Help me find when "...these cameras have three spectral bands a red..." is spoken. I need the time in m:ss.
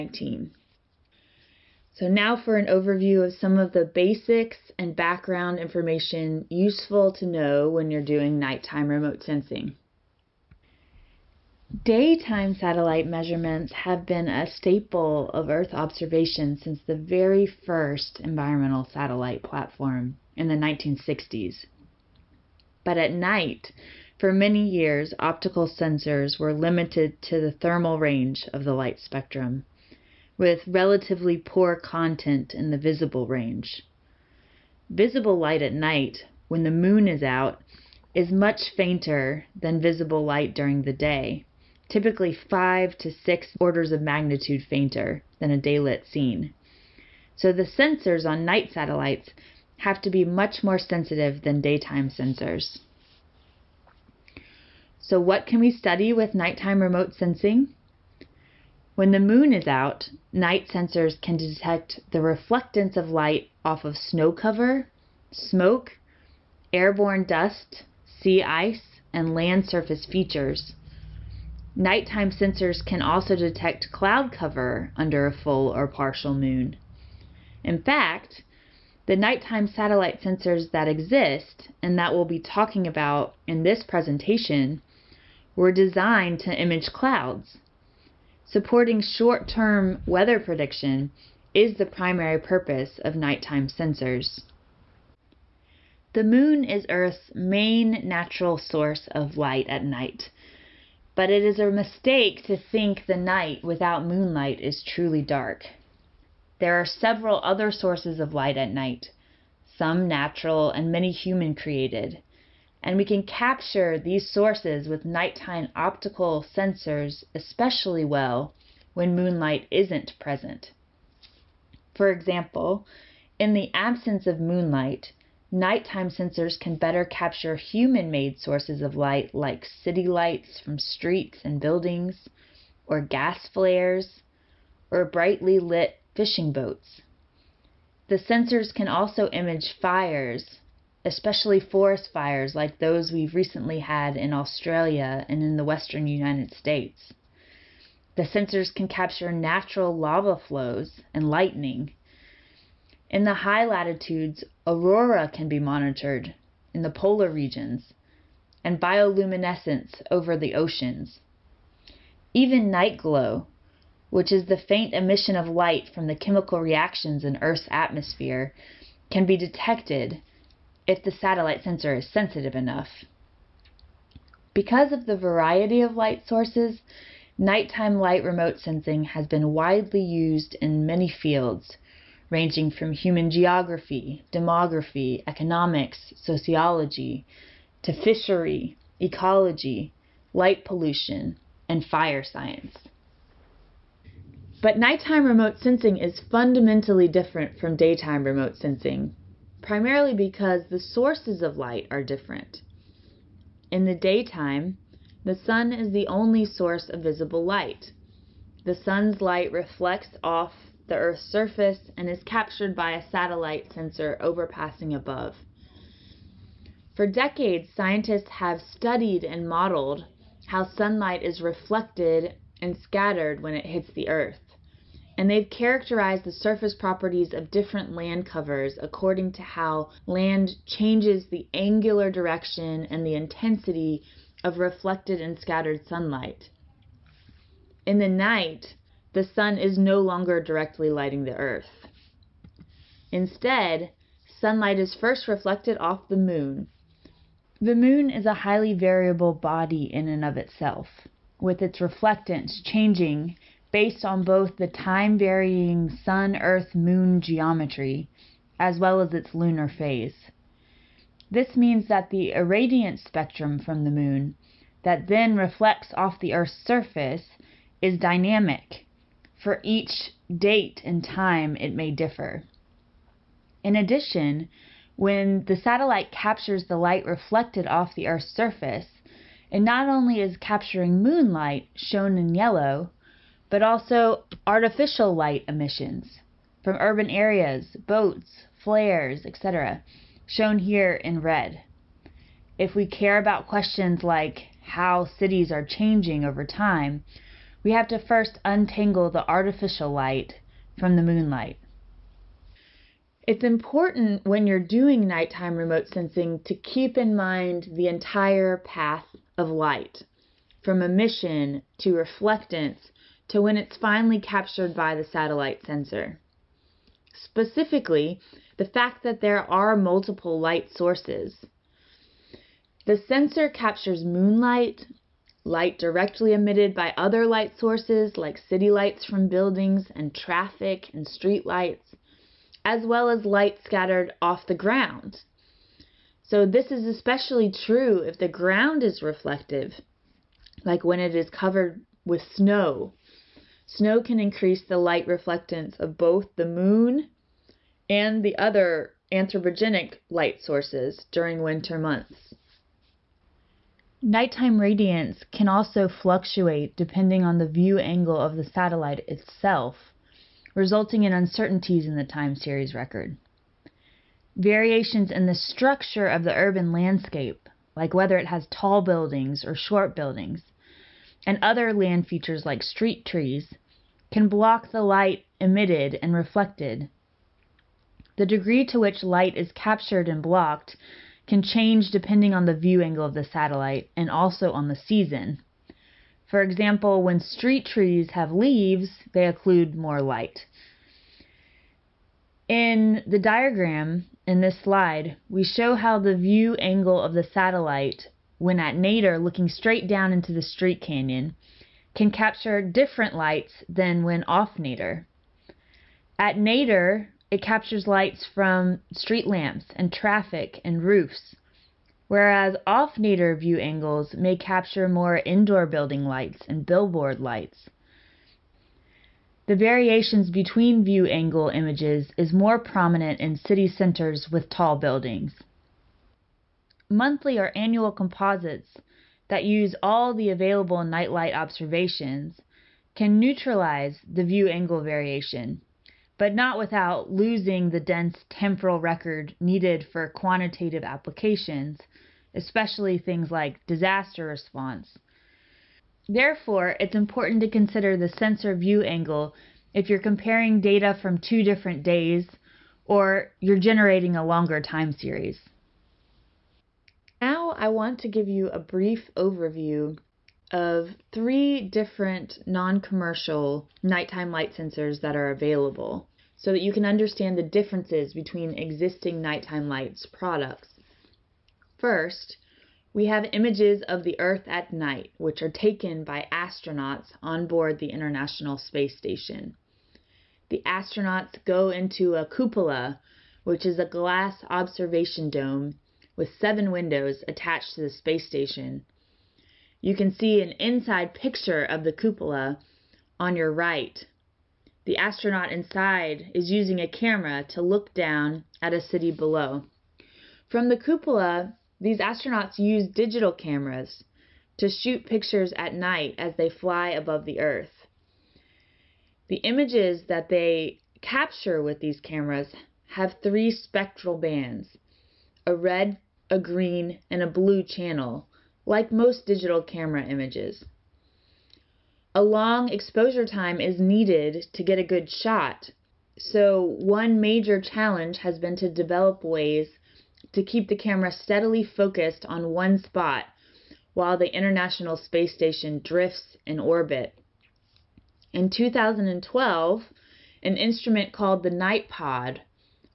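8:31.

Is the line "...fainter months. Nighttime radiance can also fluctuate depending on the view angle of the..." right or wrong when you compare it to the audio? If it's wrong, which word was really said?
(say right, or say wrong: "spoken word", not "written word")
wrong: "winter", not "fainter".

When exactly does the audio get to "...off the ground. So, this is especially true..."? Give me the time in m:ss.
5:34.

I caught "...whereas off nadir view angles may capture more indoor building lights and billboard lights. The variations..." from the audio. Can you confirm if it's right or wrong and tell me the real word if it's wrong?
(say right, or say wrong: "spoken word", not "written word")
right.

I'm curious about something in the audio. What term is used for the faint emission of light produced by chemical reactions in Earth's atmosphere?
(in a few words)
Night glow.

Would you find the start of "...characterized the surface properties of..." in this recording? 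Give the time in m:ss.
3:45.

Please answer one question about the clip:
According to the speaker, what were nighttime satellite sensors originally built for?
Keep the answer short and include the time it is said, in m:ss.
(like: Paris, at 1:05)
Short-term weather prediction, at 1:28.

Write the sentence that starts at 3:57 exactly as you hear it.
In the night, the sun is no longer directly lighting the earth.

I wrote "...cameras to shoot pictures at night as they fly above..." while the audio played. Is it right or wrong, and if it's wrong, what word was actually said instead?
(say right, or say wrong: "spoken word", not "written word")
right.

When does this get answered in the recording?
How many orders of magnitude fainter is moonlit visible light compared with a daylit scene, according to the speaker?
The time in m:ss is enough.
0:42.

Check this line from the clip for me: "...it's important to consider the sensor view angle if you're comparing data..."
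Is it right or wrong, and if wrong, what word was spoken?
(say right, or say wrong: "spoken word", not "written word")
right.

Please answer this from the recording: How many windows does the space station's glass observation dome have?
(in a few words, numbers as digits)
7.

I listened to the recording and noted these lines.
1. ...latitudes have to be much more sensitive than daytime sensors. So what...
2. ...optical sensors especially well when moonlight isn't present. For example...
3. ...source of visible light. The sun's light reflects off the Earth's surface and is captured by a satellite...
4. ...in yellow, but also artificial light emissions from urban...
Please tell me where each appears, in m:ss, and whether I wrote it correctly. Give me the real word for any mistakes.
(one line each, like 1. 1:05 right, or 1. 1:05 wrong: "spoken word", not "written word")
1. 0:48 wrong: "satellites", not "latitudes"
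2. 1:55 right
3. 3:26 right
4. 4:42 right.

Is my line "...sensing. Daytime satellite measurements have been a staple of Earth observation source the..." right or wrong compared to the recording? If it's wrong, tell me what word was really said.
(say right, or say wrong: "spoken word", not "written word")
wrong: "since", not "source".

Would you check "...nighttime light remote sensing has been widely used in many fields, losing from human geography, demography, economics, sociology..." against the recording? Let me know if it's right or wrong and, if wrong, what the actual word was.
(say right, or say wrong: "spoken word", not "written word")
wrong: "ranging", not "losing".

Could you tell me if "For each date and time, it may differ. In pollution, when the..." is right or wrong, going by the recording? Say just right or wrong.
wrong.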